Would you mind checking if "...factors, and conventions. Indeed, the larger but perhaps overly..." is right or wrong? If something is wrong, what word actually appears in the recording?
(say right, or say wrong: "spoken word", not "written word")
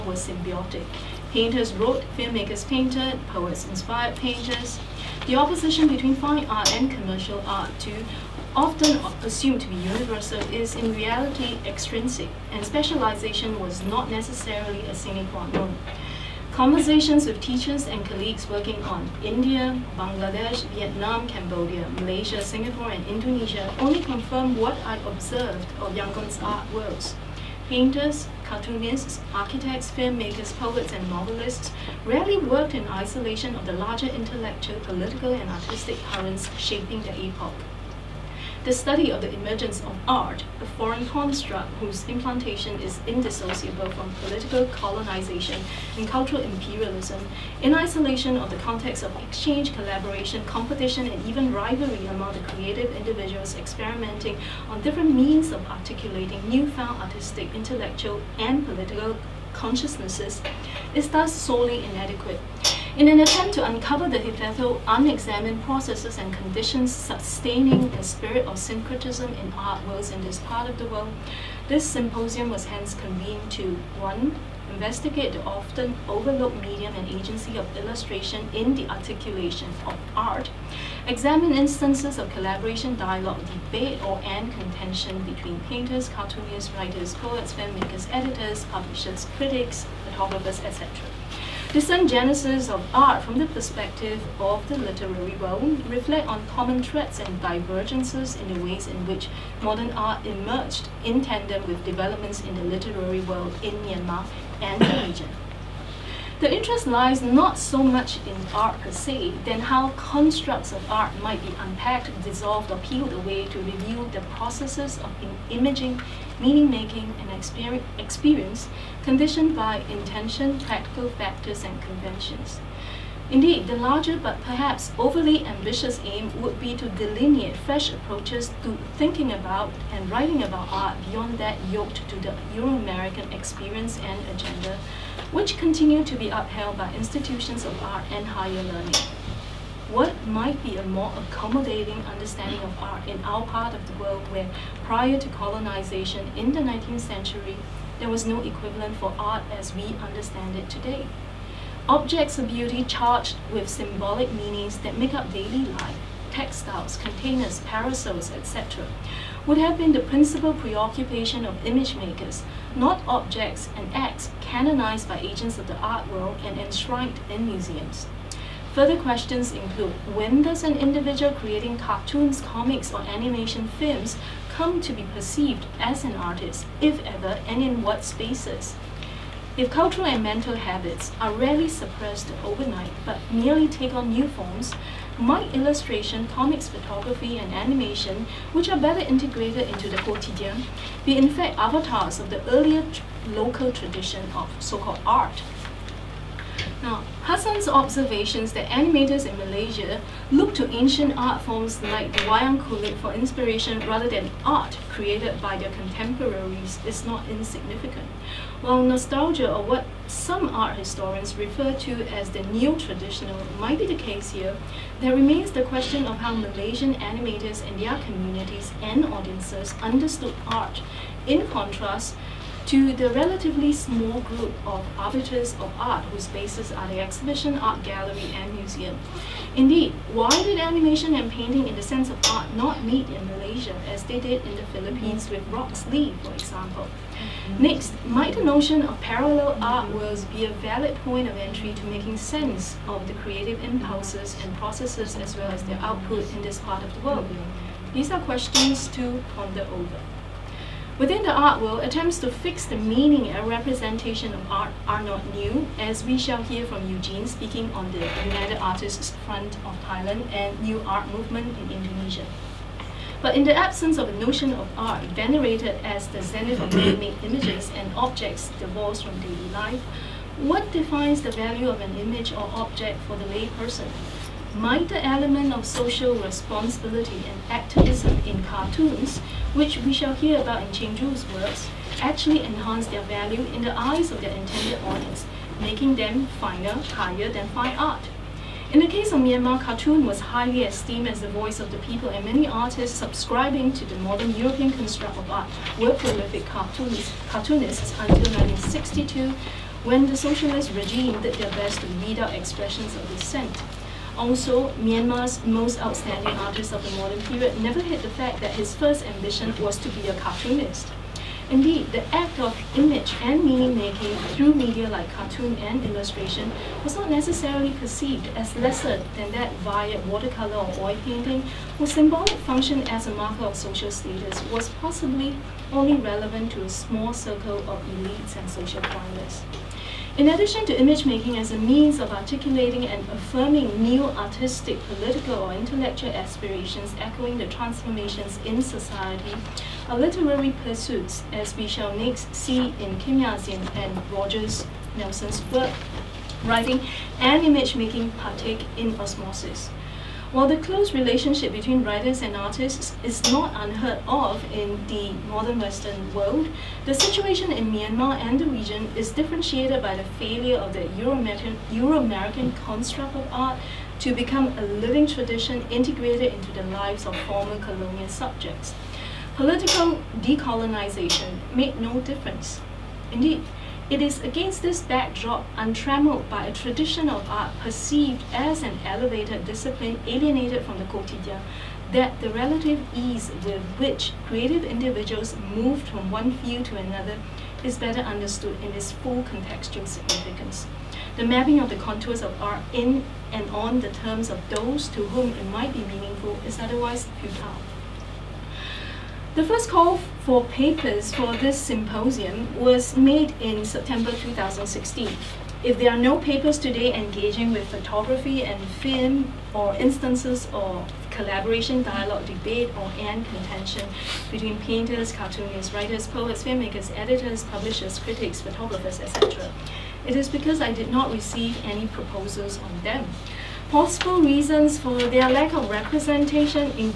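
right.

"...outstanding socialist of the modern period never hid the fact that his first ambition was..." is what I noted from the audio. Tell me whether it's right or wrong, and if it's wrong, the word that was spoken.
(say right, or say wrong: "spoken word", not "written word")
wrong: "artist", not "socialist".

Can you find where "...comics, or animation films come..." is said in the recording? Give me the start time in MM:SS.
02:52.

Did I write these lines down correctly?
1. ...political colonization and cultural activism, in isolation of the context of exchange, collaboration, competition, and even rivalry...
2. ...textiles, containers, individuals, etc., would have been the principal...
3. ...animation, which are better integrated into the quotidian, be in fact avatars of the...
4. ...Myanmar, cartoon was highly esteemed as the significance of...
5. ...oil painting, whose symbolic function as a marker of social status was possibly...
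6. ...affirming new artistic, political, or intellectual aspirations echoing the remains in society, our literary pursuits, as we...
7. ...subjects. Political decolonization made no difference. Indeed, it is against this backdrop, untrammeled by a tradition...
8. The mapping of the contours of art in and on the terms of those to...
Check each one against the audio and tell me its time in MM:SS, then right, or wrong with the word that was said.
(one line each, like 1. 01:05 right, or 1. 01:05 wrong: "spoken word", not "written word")
1. 00:44 wrong: "imperialism", not "activism"
2. 02:36 wrong: "parasols", not "individuals"
3. 03:07 right
4. 04:49 wrong: "voice", not "significance"
5. 05:20 right
6. 05:33 wrong: "transformations", not "remains"
7. 06:08 right
8. 06:31 right.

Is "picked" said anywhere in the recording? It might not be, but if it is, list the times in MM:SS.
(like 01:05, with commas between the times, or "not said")
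not said.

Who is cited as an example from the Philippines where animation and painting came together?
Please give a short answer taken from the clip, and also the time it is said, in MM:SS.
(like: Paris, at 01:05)
Roxlee, at 03:55.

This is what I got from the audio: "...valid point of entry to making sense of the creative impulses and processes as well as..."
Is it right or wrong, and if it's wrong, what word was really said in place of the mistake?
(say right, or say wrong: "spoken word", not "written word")
right.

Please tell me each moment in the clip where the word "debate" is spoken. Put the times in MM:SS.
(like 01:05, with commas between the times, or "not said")
01:23, 06:52.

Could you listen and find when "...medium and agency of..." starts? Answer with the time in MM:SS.
01:16.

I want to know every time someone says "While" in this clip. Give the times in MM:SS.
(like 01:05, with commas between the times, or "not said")
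03:28, 05:50.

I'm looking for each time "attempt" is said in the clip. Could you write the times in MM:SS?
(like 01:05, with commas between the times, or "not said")
01:03, 04:11.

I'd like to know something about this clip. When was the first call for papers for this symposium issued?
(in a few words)
September 2016.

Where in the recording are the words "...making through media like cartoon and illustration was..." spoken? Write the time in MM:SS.
05:13.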